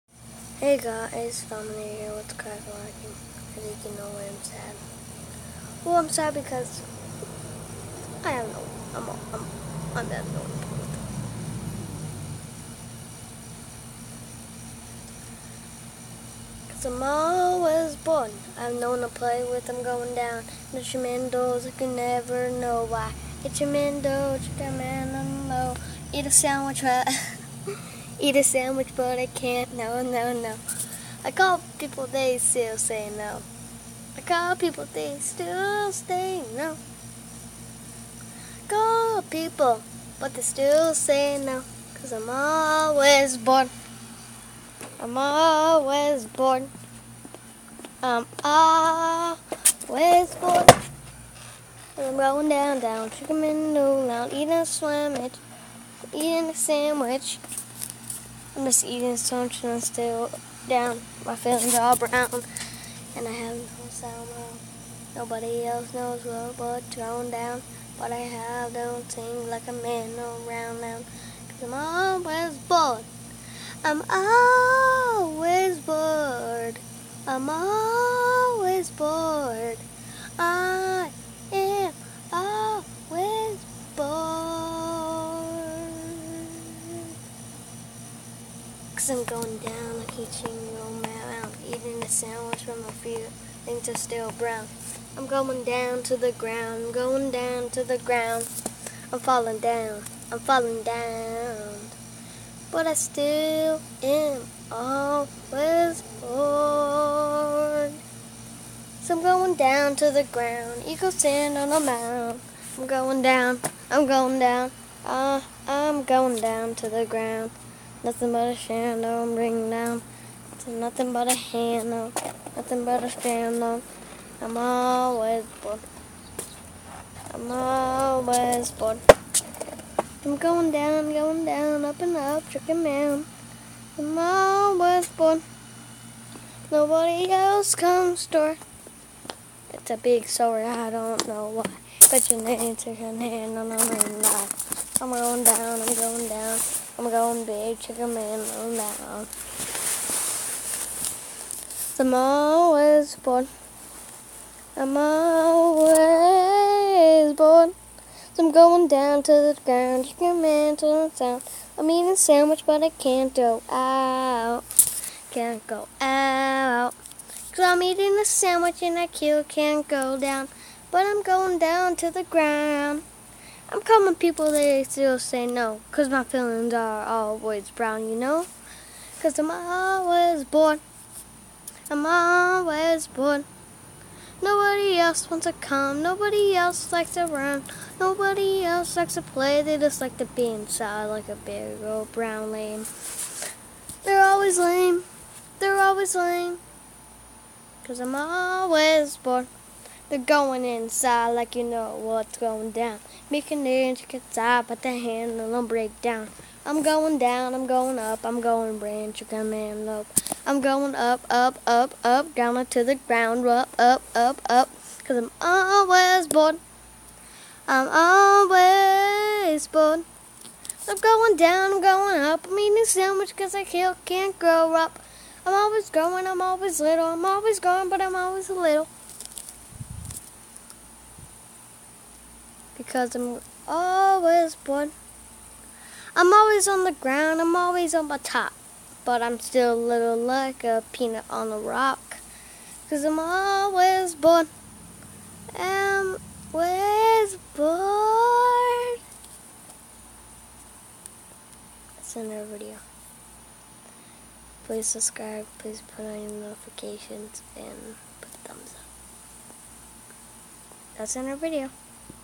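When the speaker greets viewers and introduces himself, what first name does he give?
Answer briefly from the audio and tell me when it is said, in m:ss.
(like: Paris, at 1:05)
Dominic, at 0:01.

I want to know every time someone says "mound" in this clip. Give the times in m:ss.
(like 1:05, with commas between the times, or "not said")
1:51.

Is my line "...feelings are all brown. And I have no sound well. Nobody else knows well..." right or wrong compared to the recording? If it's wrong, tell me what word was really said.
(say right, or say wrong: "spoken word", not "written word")
right.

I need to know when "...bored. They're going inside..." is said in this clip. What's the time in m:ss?
3:19.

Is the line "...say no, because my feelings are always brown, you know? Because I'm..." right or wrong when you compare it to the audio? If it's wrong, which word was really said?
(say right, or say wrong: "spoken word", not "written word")
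right.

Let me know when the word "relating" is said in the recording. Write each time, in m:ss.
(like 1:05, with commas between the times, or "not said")
not said.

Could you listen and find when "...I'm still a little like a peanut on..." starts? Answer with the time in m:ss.
3:59.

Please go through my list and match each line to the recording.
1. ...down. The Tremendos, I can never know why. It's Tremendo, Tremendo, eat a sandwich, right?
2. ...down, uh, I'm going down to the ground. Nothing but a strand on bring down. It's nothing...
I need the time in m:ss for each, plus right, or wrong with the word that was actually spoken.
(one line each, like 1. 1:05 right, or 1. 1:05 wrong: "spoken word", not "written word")
1. 0:20 right
2. 1:54 right.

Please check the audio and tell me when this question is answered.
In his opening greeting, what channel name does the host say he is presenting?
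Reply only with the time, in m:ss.
0:02.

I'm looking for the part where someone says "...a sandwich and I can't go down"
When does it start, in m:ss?
2:48.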